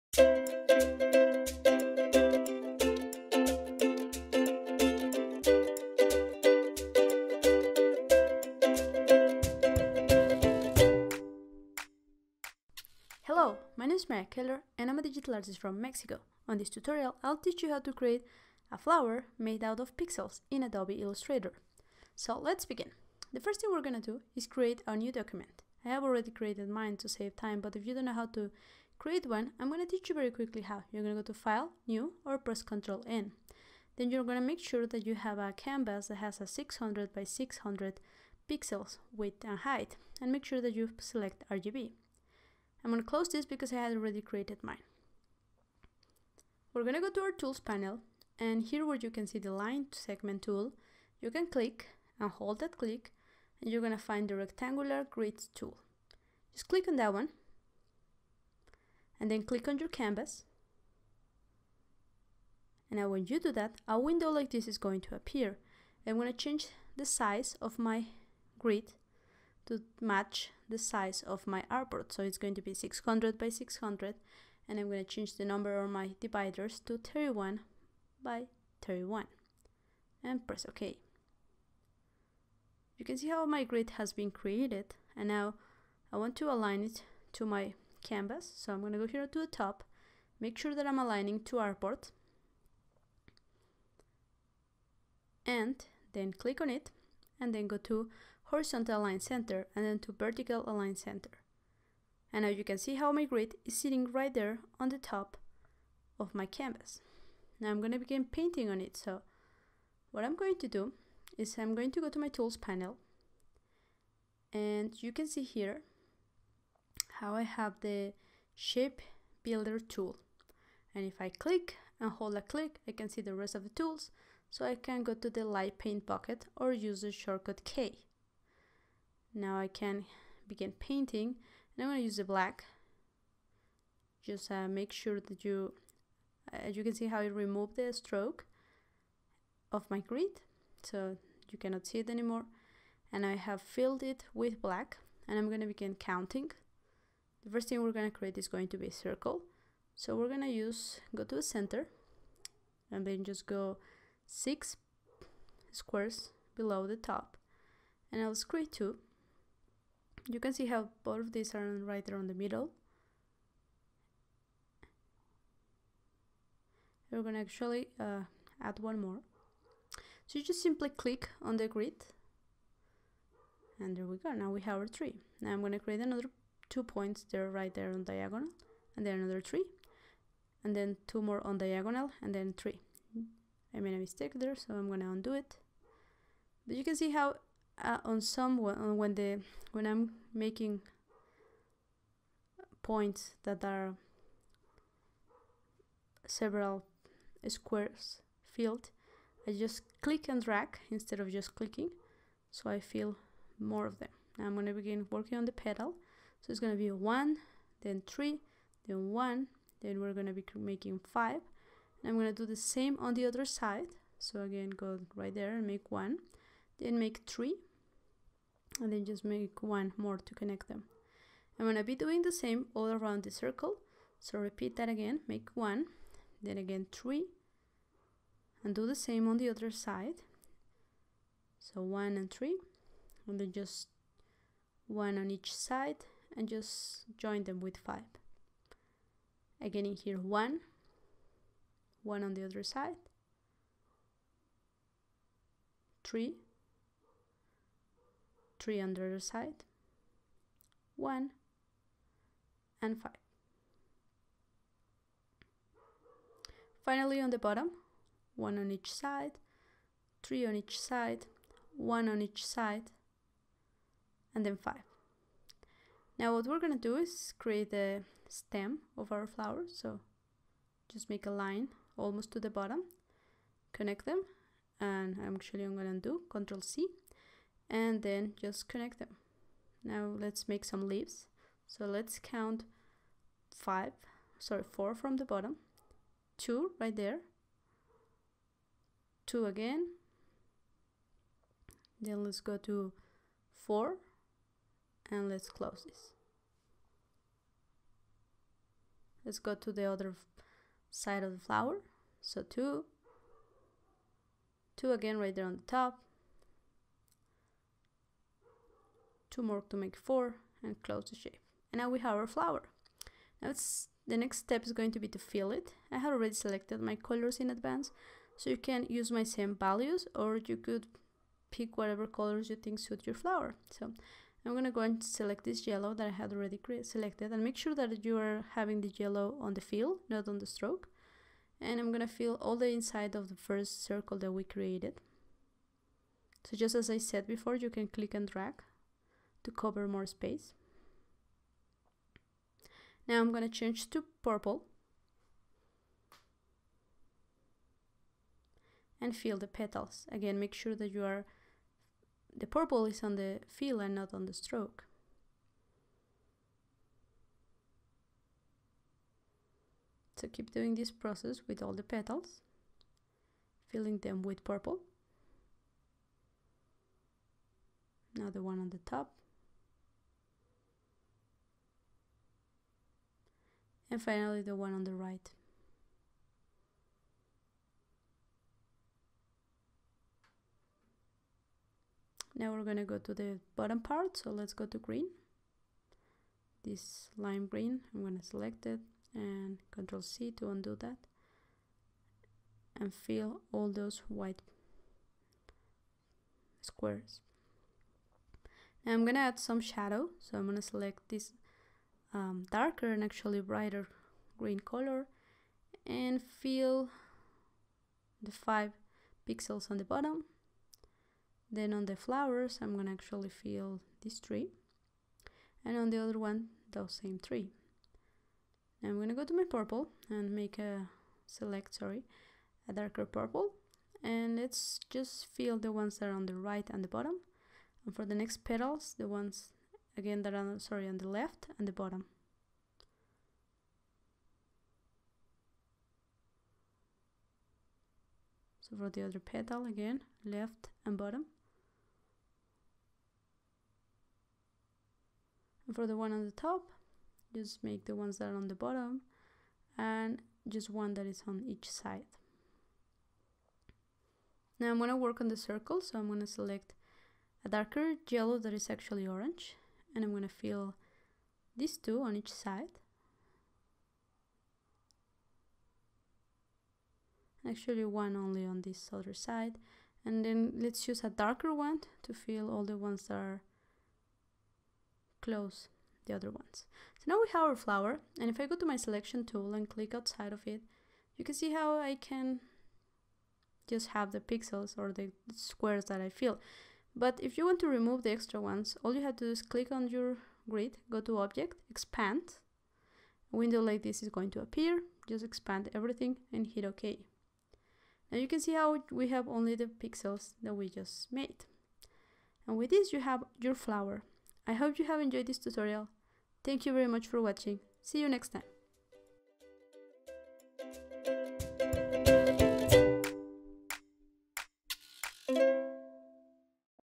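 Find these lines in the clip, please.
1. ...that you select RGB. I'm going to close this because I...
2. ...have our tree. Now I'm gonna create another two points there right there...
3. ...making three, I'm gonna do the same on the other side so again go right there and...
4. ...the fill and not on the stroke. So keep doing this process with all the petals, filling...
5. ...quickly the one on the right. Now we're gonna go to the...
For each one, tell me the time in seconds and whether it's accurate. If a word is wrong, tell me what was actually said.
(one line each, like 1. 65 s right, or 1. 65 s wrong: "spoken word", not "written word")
1. 40 s right
2. 174 s right
3. 210 s wrong: "five", not "three"
4. 353 s right
5. 374 s wrong: "finally", not "quickly".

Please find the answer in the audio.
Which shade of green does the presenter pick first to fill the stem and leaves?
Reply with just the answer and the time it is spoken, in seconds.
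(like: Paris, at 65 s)
Lime green, at 387 s.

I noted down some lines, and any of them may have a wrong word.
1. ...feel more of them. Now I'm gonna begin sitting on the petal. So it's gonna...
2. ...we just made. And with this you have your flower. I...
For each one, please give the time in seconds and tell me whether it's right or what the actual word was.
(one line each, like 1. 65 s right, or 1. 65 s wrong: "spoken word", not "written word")
1. 202 s wrong: "working", not "sitting"
2. 500 s right.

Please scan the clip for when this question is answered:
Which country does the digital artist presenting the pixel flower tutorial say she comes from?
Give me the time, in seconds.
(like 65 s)
15 s.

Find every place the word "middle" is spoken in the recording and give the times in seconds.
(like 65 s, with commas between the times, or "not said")
162 s.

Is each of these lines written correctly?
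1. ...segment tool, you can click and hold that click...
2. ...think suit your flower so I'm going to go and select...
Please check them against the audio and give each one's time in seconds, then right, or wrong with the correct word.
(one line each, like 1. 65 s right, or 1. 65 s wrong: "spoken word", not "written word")
1. 49 s right
2. 322 s right.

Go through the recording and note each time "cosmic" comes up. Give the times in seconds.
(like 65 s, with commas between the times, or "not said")
not said.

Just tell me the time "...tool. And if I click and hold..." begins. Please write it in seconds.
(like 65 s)
119 s.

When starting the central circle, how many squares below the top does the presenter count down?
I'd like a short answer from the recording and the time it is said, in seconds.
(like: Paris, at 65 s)
6, at 154 s.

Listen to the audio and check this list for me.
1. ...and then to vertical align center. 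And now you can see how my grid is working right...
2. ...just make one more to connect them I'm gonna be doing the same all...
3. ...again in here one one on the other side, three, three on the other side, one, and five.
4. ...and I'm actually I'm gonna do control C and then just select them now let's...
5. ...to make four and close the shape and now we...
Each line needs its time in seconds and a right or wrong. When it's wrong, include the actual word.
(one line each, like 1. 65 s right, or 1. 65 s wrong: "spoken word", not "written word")
1. 99 s wrong: "sitting", not "working"
2. 219 s right
3. 239 s right
4. 274 s wrong: "connect", not "select"
5. 309 s right.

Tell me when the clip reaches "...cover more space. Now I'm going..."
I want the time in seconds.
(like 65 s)
339 s.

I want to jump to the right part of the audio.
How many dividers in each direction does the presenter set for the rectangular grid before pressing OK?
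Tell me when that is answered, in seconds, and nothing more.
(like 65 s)
76 s.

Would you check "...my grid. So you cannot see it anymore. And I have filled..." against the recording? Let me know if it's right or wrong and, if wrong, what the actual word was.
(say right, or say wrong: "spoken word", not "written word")
right.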